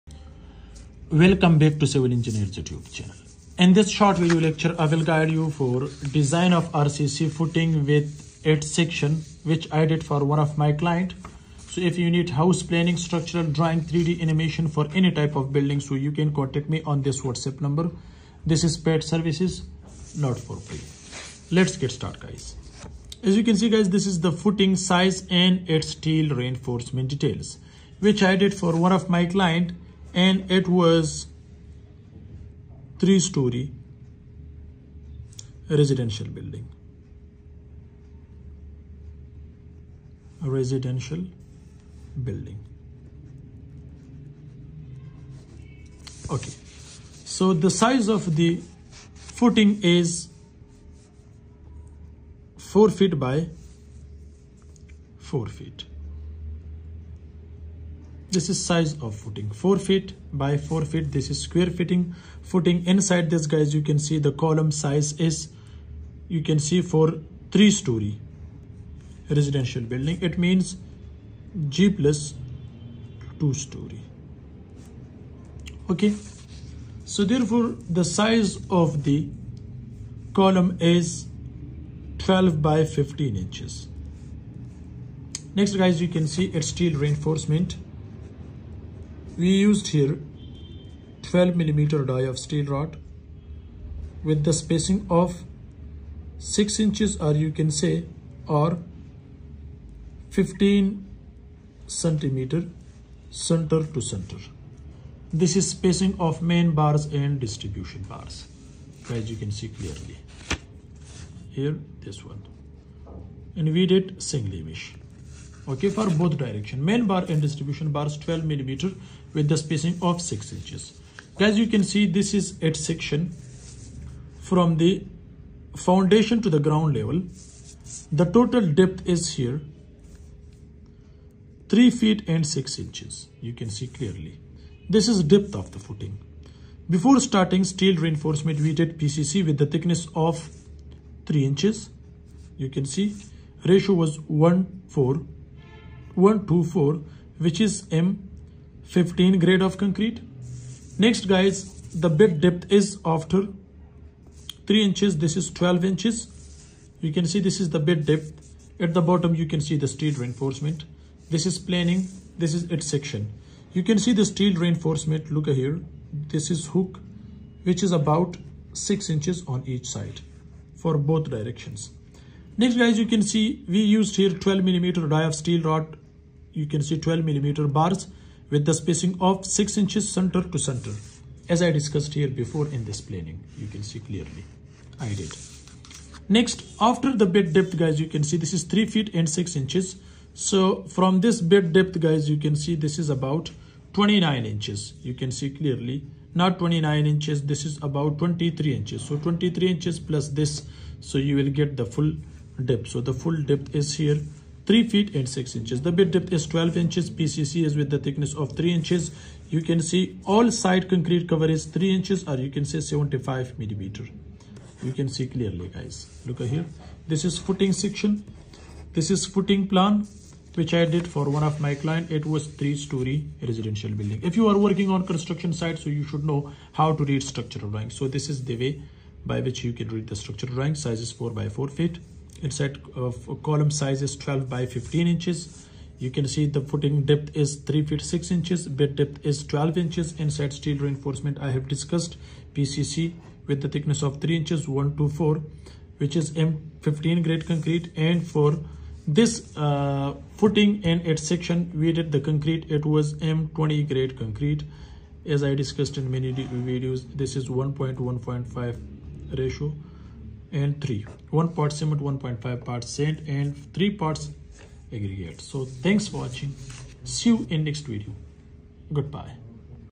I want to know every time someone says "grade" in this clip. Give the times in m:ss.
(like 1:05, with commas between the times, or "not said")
2:29, 4:07, 4:13.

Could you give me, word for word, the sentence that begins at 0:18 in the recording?
This is paid services, not for free.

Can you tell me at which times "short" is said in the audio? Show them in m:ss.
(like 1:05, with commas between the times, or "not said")
0:03.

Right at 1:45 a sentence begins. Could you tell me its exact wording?
This is spacing of main bars and distribution bars as you can see clearly.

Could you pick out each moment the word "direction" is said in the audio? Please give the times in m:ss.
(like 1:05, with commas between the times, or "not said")
1:56, 2:51.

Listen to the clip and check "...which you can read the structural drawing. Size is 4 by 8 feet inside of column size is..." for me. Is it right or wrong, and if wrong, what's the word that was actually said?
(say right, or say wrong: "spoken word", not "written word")
wrong: "4", not "8".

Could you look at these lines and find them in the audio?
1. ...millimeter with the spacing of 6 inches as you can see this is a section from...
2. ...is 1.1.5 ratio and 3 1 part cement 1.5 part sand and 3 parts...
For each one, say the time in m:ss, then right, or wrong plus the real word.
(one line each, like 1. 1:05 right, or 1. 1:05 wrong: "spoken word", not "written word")
1. 1:58 right
2. 4:17 right.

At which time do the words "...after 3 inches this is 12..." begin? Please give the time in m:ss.
2:33.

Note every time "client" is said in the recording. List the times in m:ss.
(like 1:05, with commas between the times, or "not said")
0:10, 0:29, 3:41.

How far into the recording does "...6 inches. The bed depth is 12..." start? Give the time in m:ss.
3:25.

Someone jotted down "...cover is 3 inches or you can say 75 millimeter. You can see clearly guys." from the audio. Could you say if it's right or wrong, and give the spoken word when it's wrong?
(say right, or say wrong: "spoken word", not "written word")
right.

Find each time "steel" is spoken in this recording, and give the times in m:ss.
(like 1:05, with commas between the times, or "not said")
0:25, 1:26, 1:32, 2:17, 2:39, 2:44, 2:55, 4:00.